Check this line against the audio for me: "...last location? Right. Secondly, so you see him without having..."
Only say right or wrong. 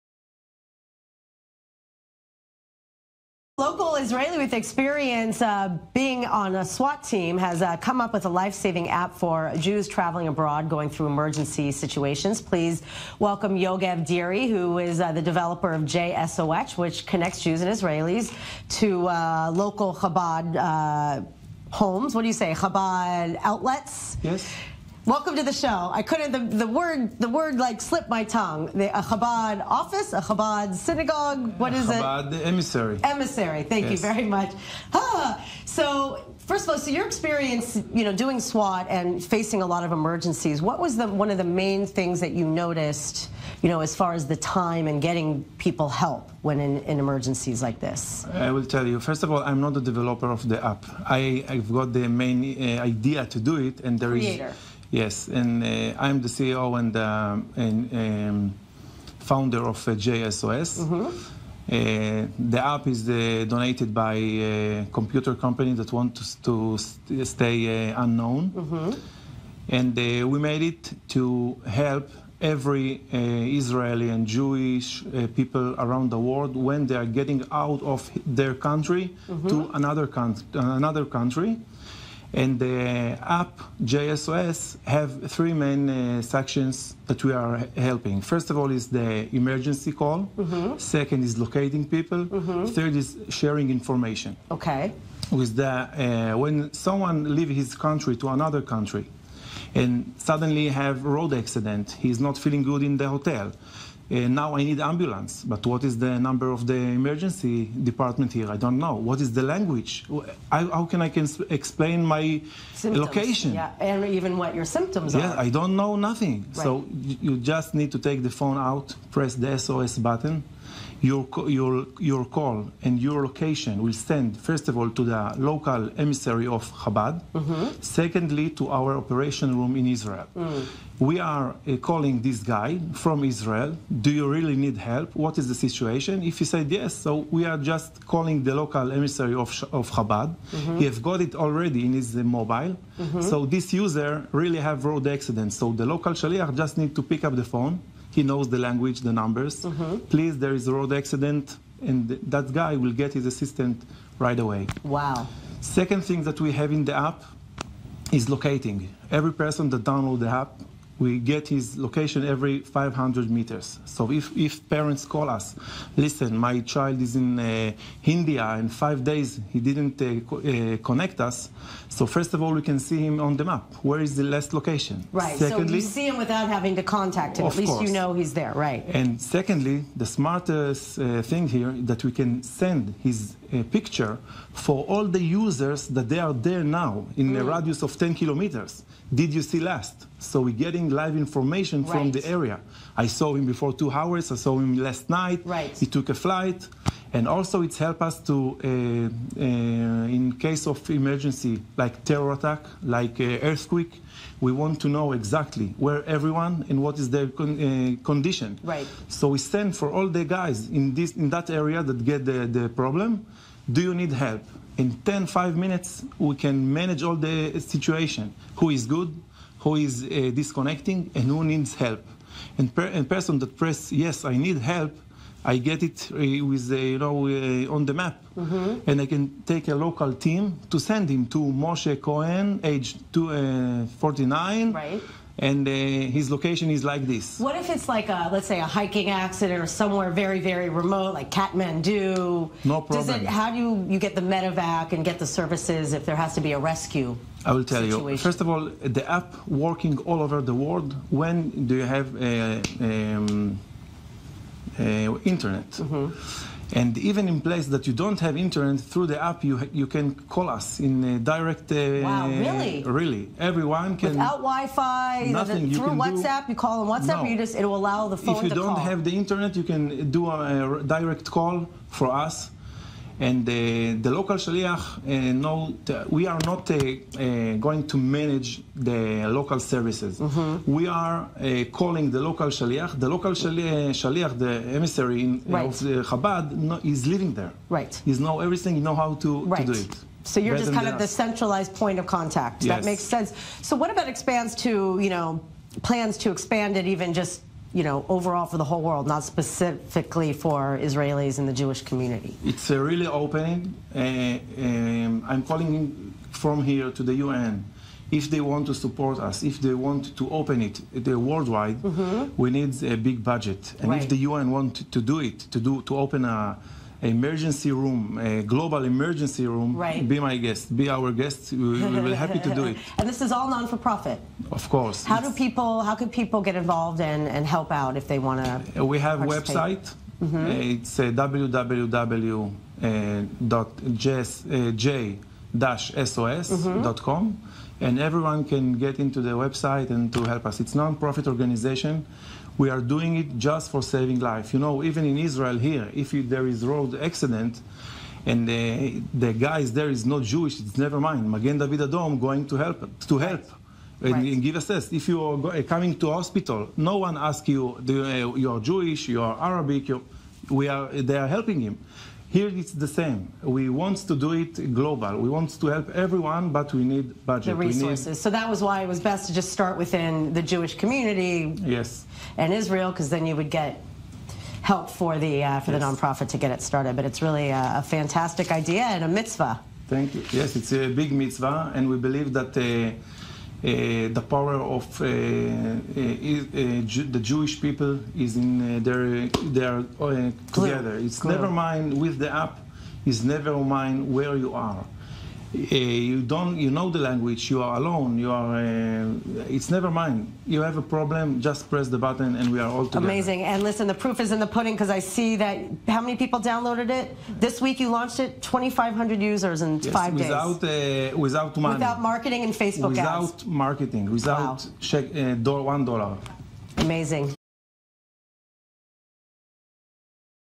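right.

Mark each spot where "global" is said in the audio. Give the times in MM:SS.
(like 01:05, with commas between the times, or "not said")
05:18, 06:04.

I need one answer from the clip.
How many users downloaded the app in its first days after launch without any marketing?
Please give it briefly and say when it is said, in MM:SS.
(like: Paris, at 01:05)
2500, at 06:48.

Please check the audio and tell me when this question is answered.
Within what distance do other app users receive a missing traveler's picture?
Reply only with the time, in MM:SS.
03:07.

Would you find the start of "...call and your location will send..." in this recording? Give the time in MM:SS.
02:02.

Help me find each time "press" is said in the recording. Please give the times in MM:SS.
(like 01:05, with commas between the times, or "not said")
01:59, 03:43, 06:41.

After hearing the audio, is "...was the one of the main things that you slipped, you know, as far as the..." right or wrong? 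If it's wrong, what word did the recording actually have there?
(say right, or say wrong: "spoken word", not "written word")
wrong: "noticed", not "slipped".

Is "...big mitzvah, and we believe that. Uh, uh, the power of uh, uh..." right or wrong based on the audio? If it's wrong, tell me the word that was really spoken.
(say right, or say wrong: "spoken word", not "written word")
right.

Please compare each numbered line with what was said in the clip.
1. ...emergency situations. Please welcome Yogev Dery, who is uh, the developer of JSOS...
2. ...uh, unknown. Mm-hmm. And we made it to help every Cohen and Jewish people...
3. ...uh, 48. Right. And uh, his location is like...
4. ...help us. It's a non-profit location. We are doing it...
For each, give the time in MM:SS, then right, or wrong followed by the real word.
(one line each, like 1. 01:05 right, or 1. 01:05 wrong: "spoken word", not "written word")
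1. 00:11 right
2. 01:07 wrong: "Israeli", not "Cohen"
3. 03:53 wrong: "49", not "48"
4. 05:40 wrong: "organization", not "location".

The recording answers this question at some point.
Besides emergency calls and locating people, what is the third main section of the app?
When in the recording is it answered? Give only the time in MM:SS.
01:33.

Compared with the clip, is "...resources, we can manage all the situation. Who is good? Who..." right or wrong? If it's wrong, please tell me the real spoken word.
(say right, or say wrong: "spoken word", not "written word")
wrong: "minutes", not "resources".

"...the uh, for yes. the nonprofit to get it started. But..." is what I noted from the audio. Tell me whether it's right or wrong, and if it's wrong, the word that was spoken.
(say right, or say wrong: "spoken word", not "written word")
right.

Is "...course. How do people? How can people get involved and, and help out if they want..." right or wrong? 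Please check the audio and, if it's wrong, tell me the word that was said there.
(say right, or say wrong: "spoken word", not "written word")
right.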